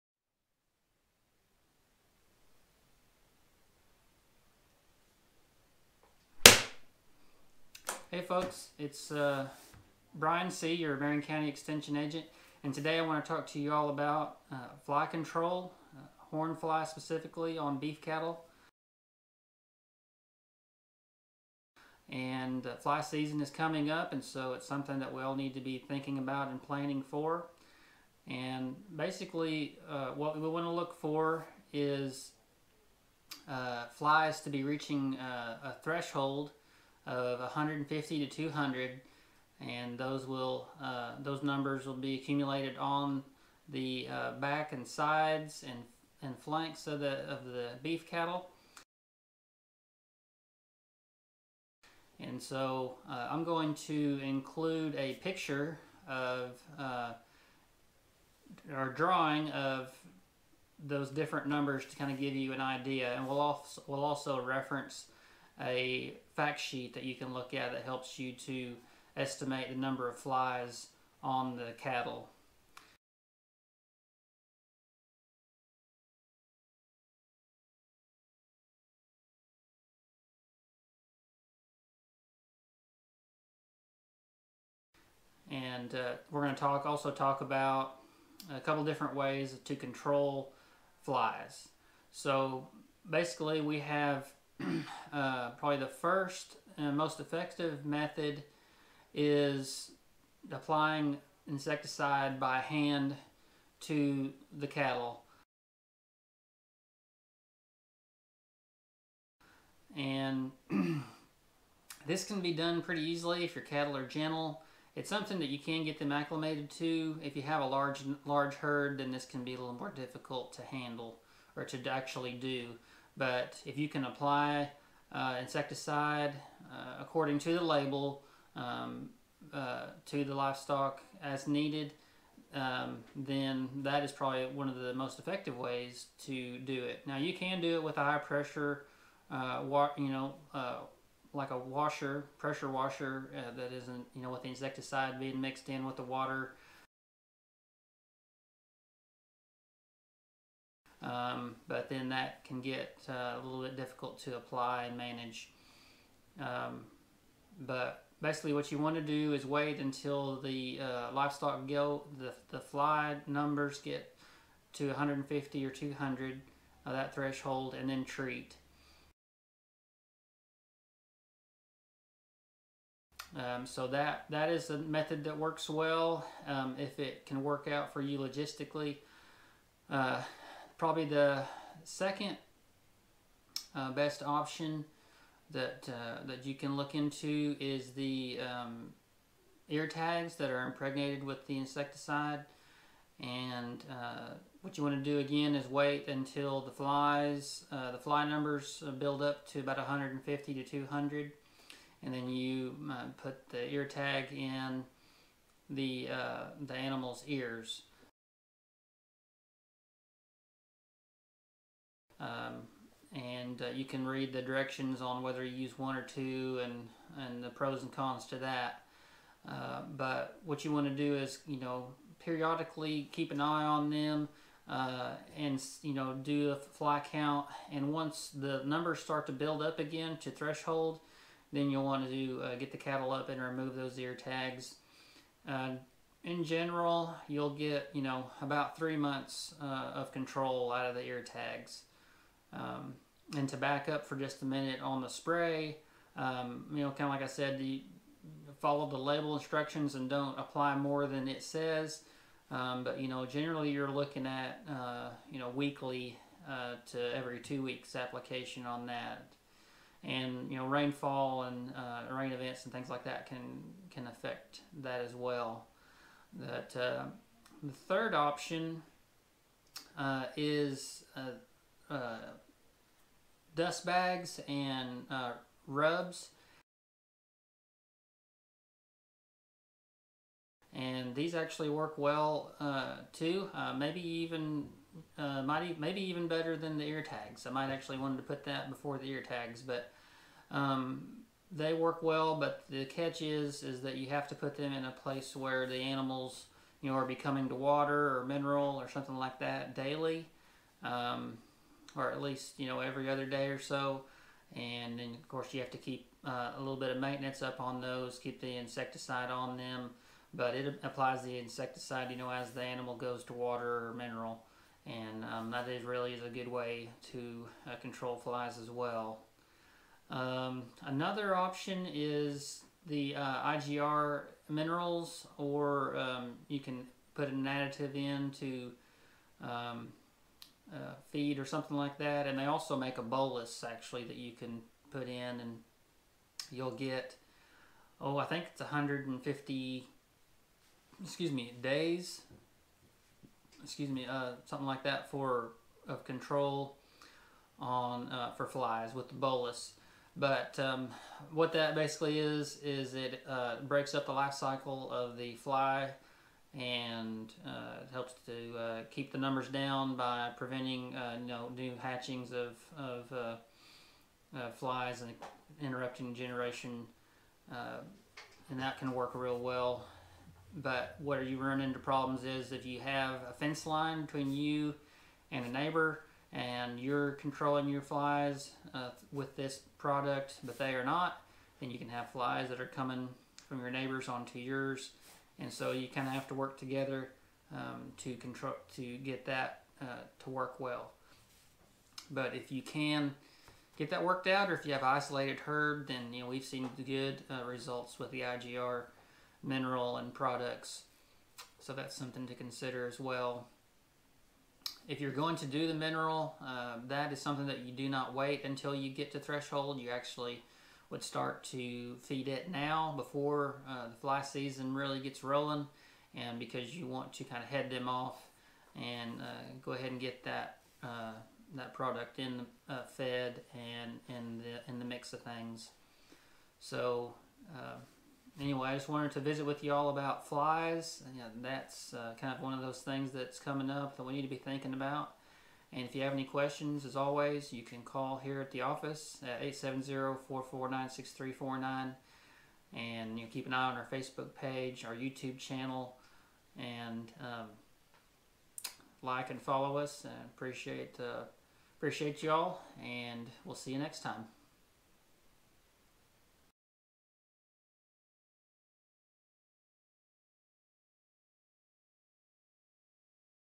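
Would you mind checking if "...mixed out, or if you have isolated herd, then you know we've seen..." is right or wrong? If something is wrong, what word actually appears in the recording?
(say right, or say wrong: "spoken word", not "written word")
wrong: "worked", not "mixed".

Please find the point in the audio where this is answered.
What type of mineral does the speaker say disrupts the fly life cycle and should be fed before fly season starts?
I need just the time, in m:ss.
5:23.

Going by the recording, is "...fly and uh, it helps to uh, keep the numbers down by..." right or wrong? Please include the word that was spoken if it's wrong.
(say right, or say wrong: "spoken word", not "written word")
right.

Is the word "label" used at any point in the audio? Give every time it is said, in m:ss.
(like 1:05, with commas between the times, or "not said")
2:07, 4:08.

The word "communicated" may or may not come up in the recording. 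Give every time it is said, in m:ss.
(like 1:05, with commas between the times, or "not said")
not said.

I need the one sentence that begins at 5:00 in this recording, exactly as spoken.
Um, or at least you know every other day or so.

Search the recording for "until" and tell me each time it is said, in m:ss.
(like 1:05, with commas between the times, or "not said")
2:39, 3:16, 6:48.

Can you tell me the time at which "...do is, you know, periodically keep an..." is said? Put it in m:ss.
3:40.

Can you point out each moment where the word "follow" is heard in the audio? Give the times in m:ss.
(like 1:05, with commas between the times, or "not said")
4:08, 7:29.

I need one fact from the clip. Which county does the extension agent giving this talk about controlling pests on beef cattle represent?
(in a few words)
Marion County.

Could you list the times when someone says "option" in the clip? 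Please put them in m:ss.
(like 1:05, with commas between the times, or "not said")
3:04, 4:28, 5:21.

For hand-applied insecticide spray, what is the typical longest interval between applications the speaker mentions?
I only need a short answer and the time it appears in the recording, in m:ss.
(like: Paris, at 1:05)
Every 2 weeks, at 4:17.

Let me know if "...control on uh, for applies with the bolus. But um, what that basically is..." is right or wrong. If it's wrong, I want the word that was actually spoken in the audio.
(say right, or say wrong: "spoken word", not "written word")
wrong: "flies", not "applies".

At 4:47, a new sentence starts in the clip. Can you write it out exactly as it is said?
I might actually wanted to put that before the ear tags, but um, they work well.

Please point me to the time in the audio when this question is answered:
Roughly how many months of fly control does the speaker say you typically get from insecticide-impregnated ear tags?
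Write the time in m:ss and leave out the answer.
3:58.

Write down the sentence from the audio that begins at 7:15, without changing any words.
And if you have any questions, as always, you can call here at the office at 870-449-6349.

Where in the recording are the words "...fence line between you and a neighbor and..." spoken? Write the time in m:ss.
6:13.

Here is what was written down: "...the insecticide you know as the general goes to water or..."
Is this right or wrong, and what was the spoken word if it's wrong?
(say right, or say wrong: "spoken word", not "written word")
wrong: "animal", not "general".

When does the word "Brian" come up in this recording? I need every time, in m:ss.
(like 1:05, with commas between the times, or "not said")
0:10.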